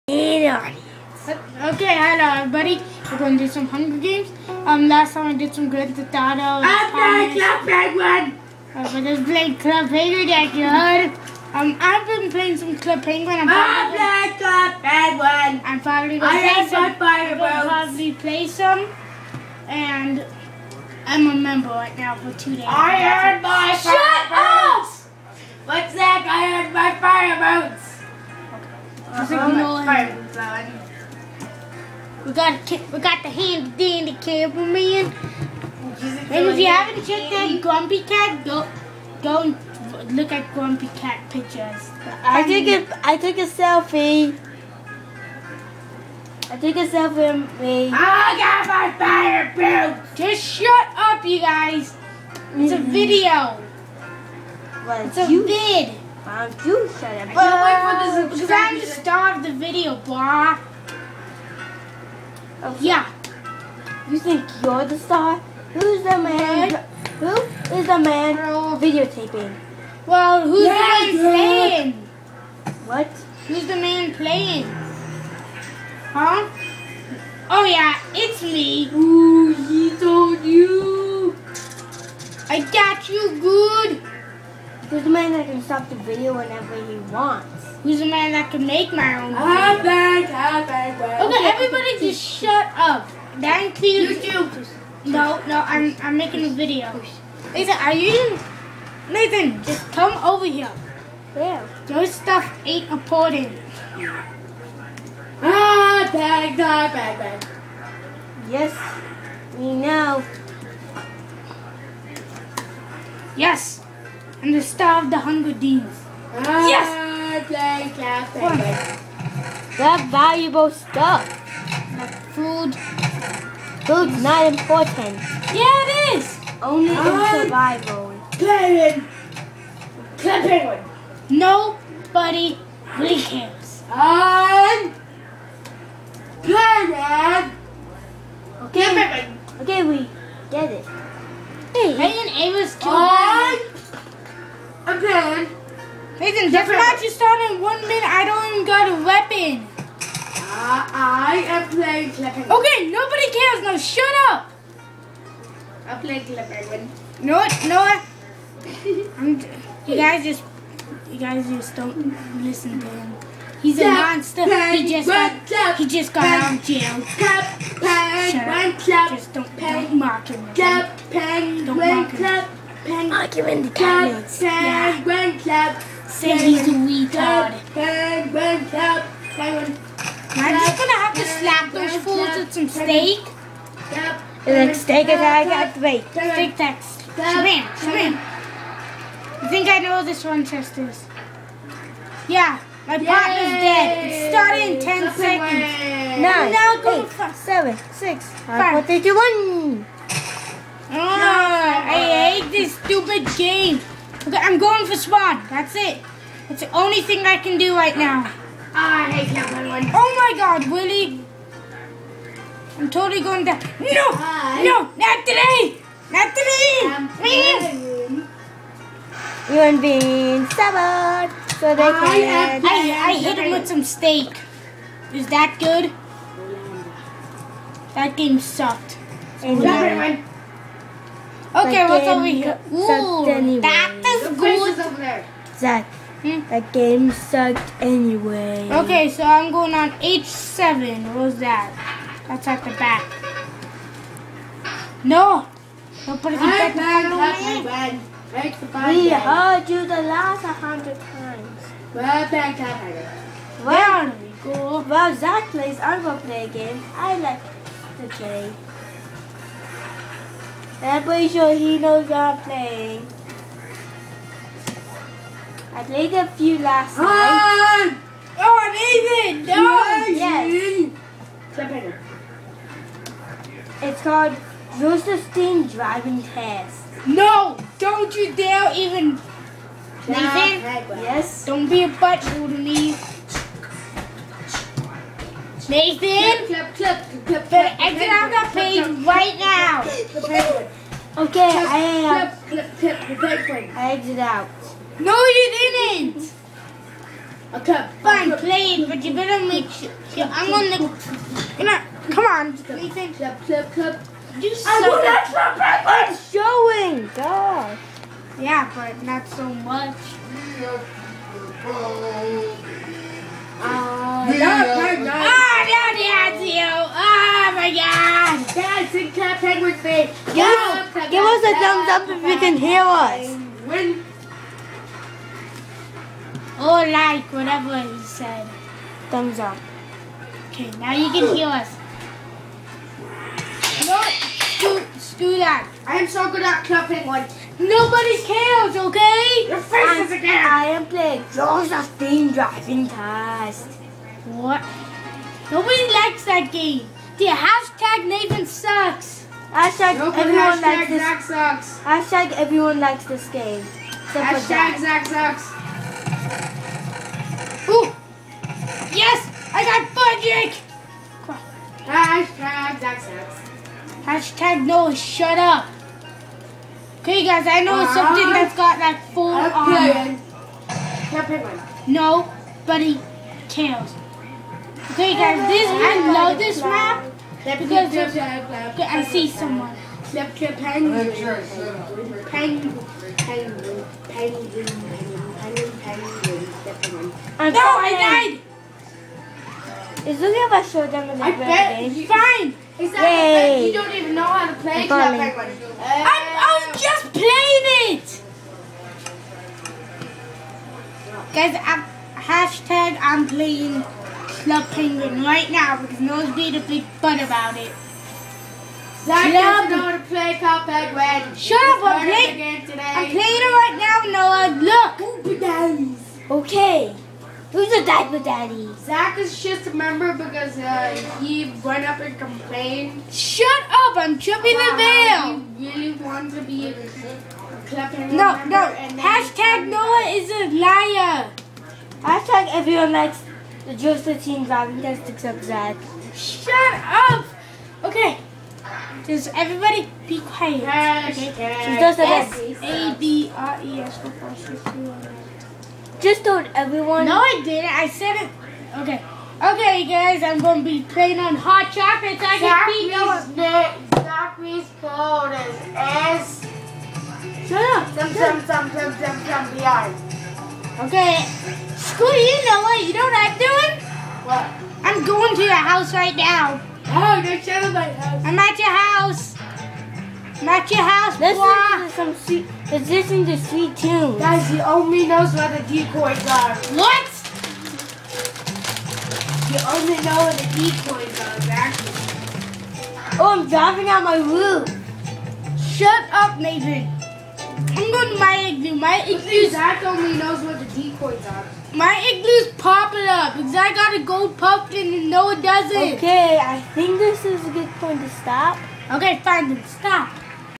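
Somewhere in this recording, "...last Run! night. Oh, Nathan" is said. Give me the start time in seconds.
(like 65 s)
266 s.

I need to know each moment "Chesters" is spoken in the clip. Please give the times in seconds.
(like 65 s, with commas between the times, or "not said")
190 s.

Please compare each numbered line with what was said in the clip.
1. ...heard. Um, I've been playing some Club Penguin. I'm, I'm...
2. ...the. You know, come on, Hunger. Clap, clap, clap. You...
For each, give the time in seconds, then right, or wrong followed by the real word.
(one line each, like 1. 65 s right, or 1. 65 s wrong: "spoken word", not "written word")
1. 10 s right
2. 300 s wrong: "Nathan", not "Hunger".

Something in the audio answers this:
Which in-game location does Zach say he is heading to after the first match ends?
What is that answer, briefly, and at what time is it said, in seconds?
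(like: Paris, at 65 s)
H7, at 239 s.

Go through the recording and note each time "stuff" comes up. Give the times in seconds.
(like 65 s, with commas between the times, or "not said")
102 s, 120 s.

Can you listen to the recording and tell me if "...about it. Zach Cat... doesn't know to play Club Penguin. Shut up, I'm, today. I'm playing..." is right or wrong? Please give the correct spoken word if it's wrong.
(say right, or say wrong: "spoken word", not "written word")
wrong: "Club", not "Cat".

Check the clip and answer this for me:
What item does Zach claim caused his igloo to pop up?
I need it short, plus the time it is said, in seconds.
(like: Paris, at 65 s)
Gold pumpkin, at 494 s.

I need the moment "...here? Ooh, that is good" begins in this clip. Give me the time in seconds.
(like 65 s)
232 s.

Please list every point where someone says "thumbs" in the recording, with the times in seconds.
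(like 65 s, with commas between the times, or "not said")
321 s, 329 s.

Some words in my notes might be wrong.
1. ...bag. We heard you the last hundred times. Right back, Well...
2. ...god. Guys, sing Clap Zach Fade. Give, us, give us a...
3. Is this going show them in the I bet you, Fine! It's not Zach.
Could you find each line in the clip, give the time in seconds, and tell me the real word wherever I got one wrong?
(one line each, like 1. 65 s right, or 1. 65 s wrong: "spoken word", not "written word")
1. 247 s right
2. 317 s wrong: "Penguin", not "Zach"
3. 390 s wrong: "Yay", not "Zach".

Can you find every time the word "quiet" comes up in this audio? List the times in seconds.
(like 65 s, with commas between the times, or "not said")
440 s.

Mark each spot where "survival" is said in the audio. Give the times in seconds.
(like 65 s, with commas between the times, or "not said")
127 s.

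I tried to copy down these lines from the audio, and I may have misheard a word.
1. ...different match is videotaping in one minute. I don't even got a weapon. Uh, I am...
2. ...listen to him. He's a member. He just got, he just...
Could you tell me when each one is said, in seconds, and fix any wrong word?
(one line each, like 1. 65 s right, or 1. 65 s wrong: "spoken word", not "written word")
1. 146 s wrong: "starting", not "videotaping"
2. 162 s wrong: "monster", not "member".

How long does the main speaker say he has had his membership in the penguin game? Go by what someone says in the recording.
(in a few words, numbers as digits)
2 days.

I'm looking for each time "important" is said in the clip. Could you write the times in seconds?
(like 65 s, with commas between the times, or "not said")
102 s, 124 s.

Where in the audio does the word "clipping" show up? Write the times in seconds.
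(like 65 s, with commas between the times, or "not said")
152 s, 156 s.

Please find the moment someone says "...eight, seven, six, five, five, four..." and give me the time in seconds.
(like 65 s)
197 s.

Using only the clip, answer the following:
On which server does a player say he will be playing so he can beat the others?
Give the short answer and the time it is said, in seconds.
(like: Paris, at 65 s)
Hot Chocolate, at 451 s.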